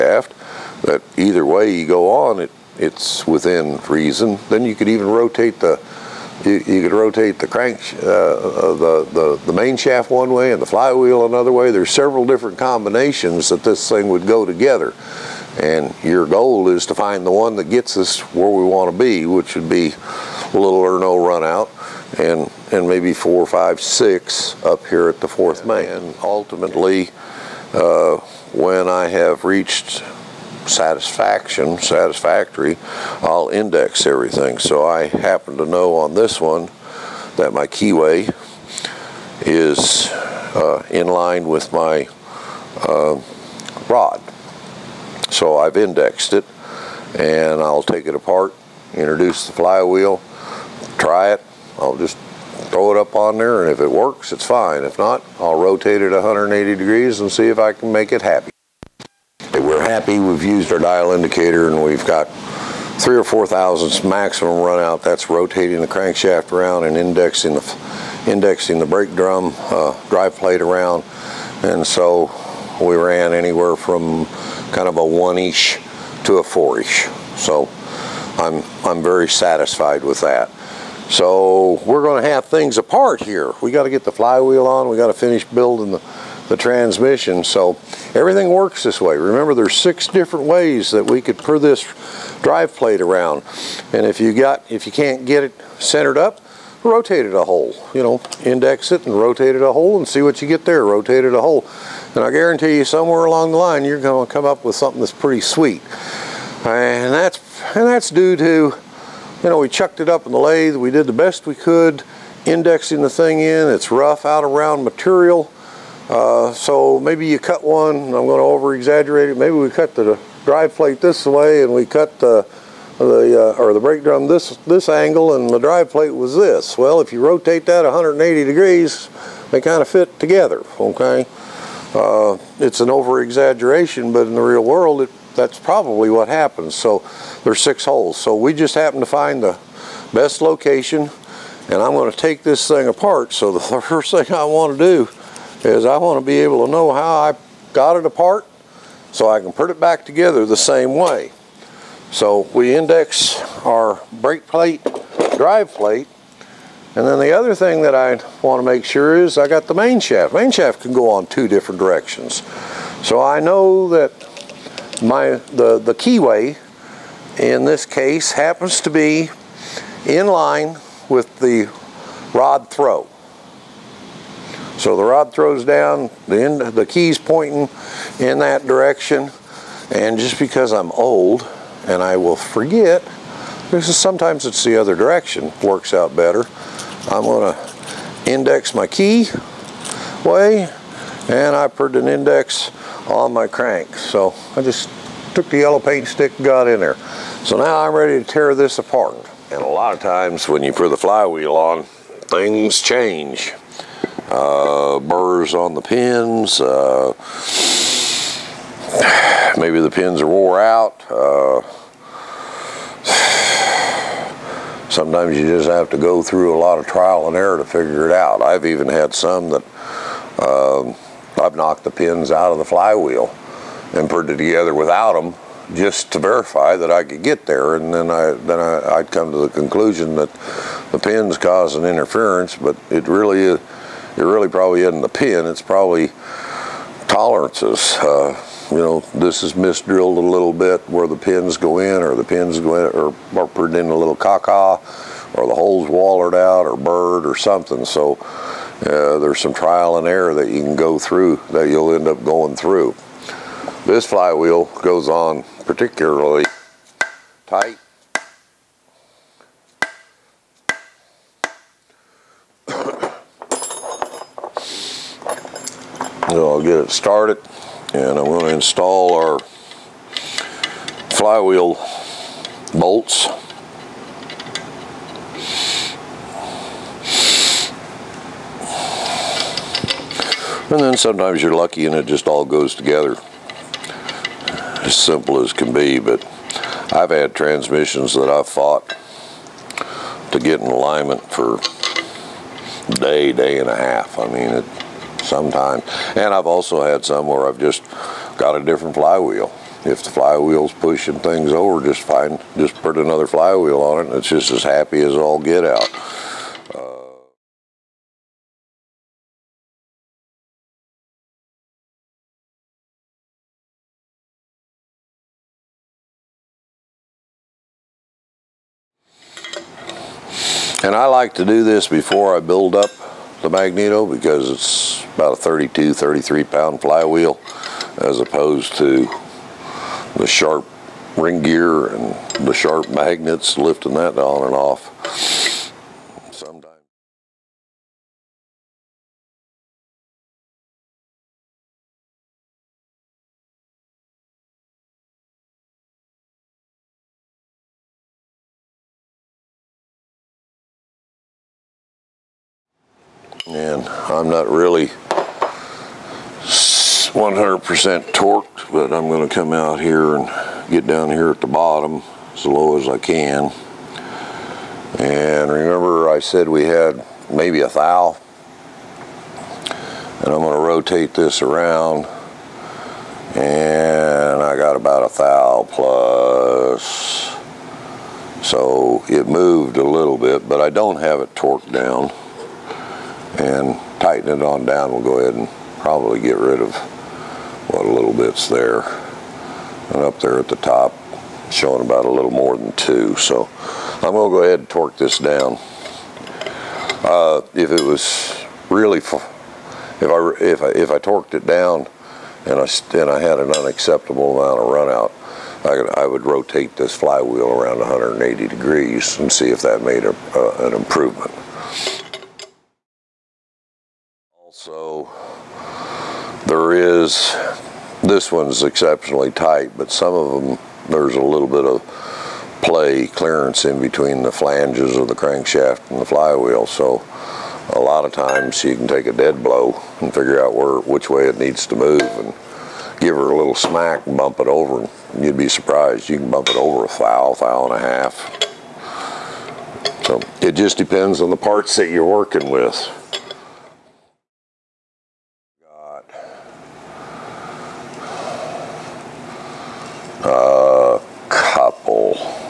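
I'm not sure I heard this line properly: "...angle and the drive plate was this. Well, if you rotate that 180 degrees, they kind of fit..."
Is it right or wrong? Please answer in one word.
right.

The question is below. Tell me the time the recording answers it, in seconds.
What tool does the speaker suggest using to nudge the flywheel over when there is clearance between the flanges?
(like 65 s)
429 s.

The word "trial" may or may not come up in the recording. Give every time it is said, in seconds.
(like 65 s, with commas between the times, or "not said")
216 s, 249 s.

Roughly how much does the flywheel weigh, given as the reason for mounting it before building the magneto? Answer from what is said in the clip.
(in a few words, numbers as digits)
32 to 33 pounds.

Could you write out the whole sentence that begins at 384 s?
We'll go ahead and probably get rid of what a little bit's there.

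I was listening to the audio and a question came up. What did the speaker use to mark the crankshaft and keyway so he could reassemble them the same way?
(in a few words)
yellow paint stick.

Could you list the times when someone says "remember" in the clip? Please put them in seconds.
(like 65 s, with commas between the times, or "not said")
89 s, 365 s.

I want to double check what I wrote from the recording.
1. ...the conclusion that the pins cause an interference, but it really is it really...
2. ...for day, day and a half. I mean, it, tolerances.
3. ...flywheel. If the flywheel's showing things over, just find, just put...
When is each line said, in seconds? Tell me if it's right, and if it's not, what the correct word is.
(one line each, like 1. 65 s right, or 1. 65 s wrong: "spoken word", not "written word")
1. 229 s right
2. 291 s wrong: "sometimes", not "tolerances"
3. 298 s wrong: "pushing", not "showing".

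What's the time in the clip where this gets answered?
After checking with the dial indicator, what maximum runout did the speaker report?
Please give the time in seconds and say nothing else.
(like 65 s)
63 s.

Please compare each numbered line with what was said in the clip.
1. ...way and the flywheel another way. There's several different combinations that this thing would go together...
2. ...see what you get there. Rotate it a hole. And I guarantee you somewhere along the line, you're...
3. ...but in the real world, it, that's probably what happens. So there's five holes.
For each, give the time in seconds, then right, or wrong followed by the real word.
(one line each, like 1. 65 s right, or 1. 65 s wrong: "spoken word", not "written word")
1. 10 s right
2. 100 s right
3. 134 s wrong: "six", not "five".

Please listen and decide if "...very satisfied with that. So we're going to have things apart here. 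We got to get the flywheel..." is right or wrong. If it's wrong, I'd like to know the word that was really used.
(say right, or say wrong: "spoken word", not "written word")
right.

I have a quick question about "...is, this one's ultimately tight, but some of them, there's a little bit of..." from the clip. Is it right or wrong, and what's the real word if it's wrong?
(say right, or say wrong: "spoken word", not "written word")
wrong: "exceptionally", not "ultimately".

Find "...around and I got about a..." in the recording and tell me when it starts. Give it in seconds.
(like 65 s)
371 s.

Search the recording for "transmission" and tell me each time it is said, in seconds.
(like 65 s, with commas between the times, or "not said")
86 s, 287 s.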